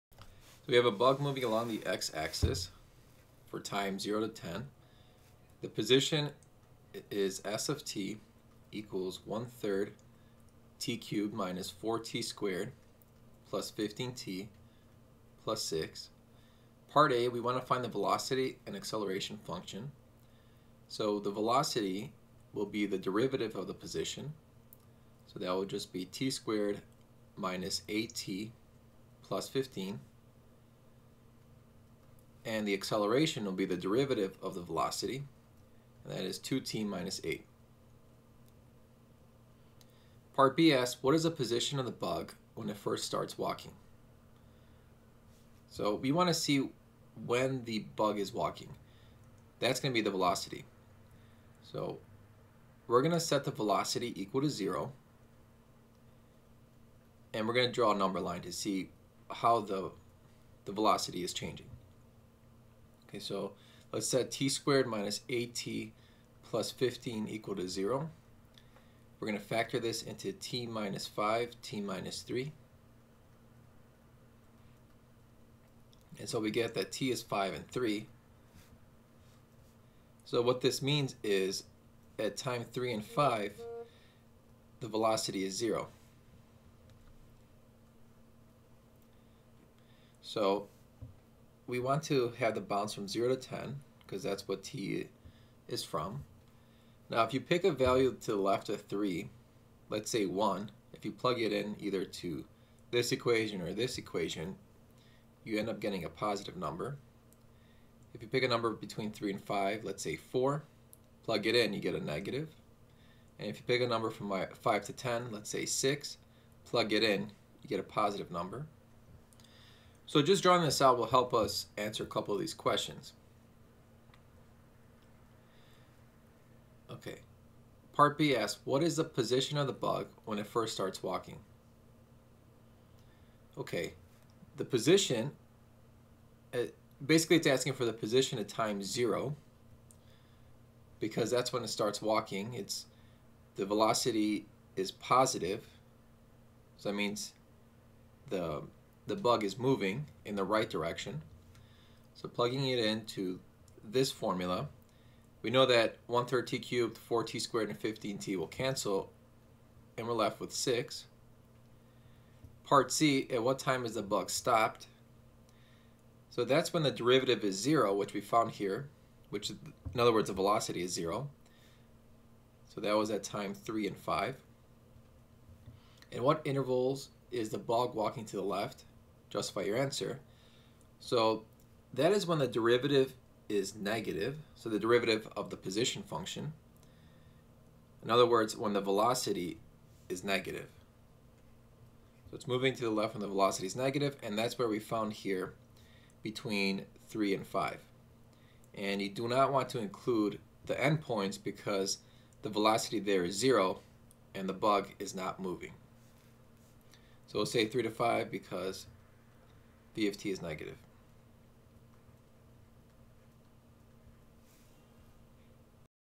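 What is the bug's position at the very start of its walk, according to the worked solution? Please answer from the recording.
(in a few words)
6.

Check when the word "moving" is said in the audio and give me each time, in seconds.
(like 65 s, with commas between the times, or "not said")
1 s, 149 s, 192 s, 205 s.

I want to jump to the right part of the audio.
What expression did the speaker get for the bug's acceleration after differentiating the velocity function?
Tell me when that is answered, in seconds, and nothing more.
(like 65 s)
36 s.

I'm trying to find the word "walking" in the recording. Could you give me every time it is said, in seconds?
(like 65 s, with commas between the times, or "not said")
43 s, 48 s, 131 s, 142 s, 177 s.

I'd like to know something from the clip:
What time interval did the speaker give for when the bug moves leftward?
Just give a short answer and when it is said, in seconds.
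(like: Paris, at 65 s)
3 to 5, at 207 s.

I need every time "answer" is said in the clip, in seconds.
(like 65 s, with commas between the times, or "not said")
121 s, 179 s.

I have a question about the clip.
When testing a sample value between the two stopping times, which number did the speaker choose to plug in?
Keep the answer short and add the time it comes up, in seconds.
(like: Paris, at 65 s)
4, at 109 s.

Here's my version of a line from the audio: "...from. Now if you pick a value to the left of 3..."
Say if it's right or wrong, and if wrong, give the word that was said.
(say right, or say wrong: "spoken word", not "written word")
right.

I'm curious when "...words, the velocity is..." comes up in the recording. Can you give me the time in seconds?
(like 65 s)
170 s.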